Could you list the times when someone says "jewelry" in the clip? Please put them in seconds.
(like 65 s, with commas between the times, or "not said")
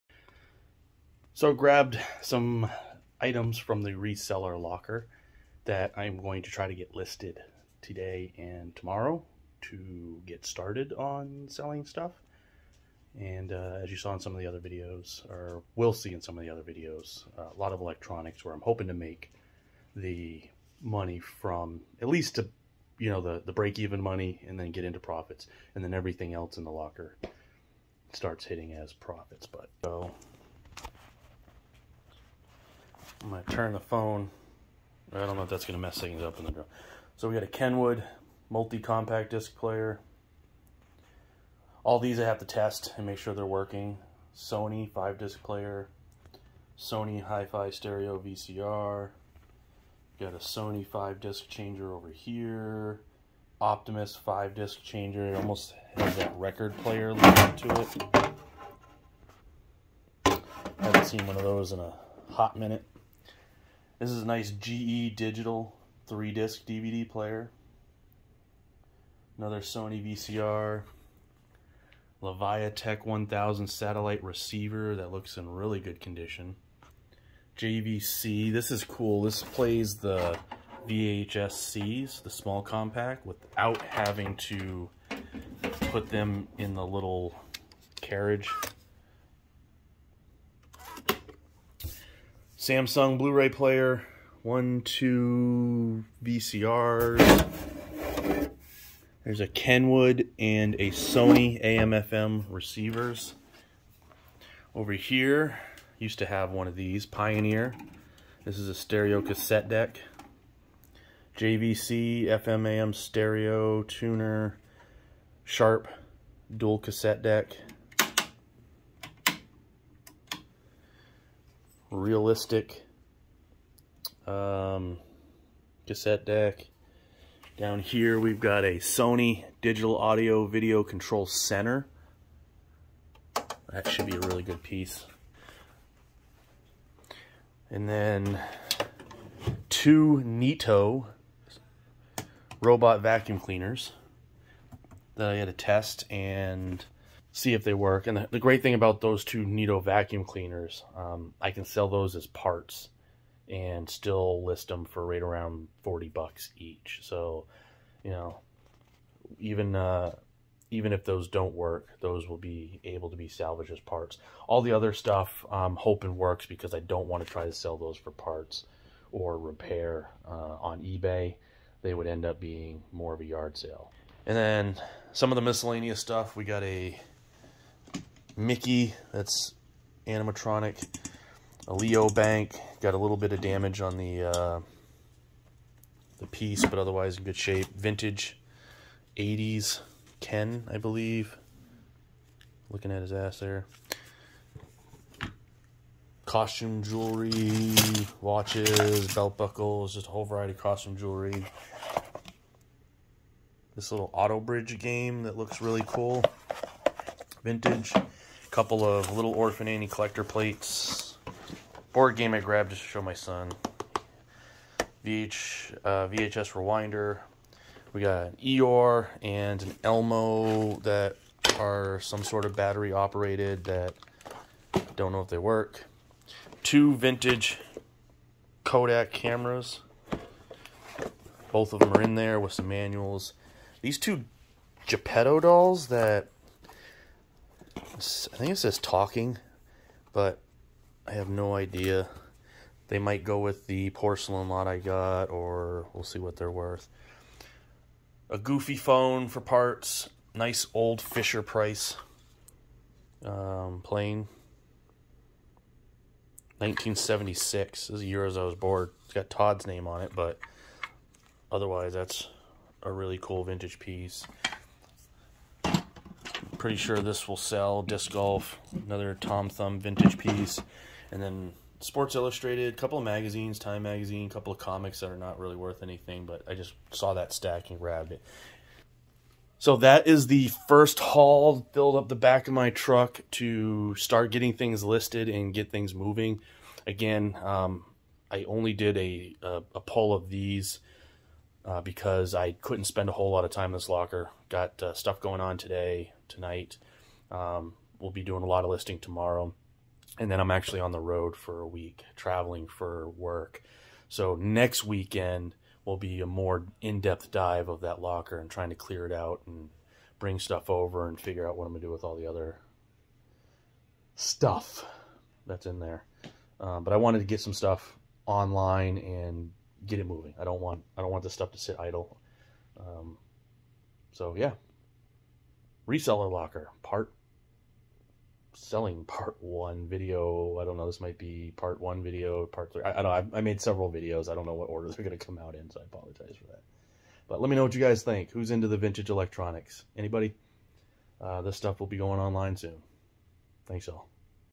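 196 s, 200 s.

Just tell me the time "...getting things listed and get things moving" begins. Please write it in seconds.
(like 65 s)
284 s.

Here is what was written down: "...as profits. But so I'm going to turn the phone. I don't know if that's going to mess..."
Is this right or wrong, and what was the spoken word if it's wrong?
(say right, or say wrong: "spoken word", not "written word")
right.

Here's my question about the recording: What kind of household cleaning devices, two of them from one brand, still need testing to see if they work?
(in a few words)
robot vacuum cleaners.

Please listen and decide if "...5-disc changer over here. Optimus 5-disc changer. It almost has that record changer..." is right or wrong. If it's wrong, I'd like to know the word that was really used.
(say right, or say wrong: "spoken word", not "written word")
wrong: "player", not "changer".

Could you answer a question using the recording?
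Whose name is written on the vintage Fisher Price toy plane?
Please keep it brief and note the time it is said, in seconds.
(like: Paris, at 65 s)
Todd, at 259 s.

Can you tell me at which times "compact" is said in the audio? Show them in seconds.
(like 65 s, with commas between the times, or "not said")
38 s, 82 s.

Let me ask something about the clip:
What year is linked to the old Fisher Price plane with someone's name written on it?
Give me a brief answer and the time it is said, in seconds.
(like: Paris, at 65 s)
1976, at 256 s.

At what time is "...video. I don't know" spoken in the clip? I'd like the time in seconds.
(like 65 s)
329 s.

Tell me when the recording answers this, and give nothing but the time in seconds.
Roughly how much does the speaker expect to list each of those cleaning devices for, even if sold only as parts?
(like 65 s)
155 s.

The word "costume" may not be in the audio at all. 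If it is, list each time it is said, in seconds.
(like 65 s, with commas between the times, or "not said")
196 s, 200 s.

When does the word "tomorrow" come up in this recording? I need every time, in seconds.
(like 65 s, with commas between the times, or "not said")
8 s, 298 s.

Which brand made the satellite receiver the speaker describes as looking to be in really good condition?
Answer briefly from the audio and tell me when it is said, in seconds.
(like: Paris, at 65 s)
Leviatech, at 72 s.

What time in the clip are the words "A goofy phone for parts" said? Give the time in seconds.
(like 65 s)
248 s.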